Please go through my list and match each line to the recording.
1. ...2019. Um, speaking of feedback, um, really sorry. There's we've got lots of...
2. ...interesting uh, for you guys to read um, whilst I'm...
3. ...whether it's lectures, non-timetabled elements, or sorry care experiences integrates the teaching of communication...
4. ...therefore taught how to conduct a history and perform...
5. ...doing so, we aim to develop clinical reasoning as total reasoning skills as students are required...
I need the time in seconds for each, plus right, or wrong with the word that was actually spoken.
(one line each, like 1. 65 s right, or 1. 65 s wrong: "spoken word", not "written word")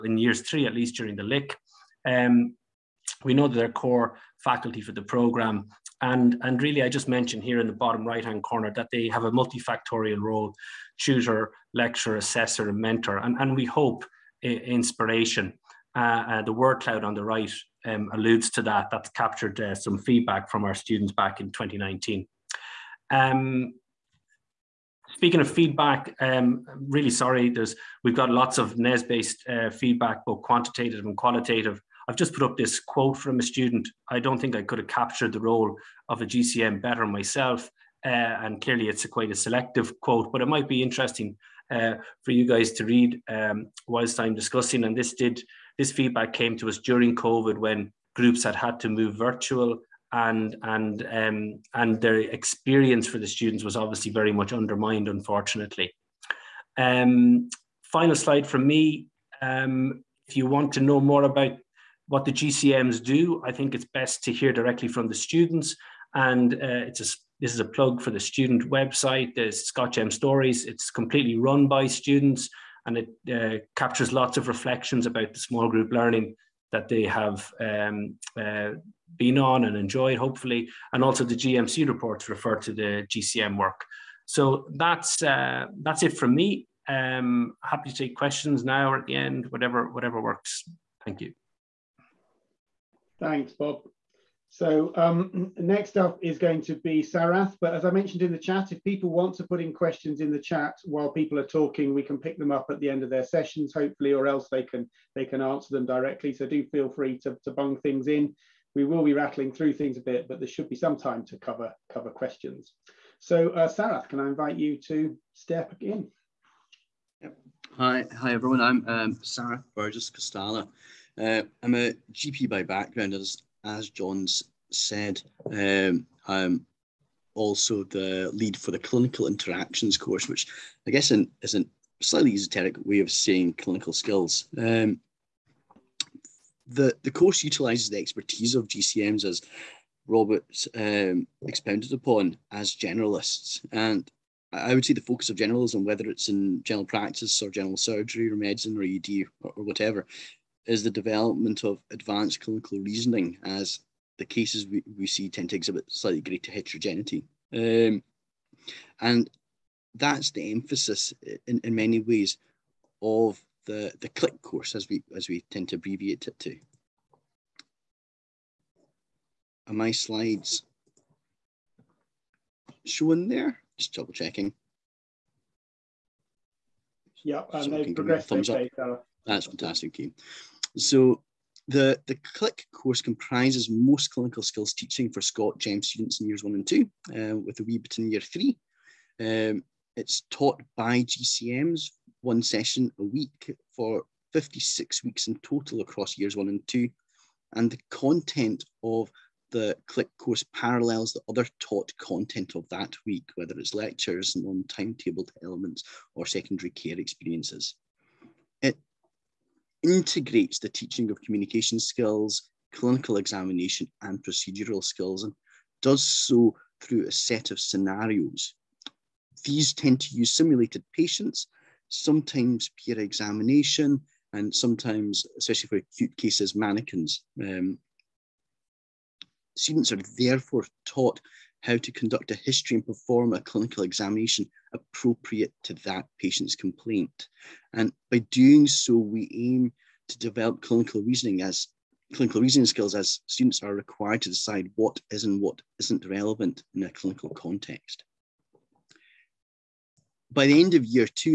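1. 21 s right
2. 40 s right
3. 203 s wrong: "secondary", not "sorry"
4. 230 s right
5. 238 s wrong: "clinical", not "total".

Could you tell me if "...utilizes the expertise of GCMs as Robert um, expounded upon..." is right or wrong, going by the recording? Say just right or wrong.
right.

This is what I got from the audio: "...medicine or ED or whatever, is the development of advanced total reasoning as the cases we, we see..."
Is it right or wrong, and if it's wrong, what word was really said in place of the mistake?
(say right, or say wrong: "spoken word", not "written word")
wrong: "clinical", not "total".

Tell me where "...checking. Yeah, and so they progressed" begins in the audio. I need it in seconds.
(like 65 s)
174 s.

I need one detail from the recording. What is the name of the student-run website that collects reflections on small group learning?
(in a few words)
ScotGEM Stories.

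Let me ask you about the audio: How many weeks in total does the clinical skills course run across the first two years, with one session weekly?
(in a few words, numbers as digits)
56.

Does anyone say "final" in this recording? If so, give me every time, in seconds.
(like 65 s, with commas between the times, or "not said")
57 s.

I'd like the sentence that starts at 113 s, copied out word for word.
So uh, Sarath, can I invite you to step in?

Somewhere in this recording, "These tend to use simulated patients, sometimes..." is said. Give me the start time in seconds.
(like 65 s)
219 s.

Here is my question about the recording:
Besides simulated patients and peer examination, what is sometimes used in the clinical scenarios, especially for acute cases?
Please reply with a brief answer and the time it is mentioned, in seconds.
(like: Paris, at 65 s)
Mannequins, at 226 s.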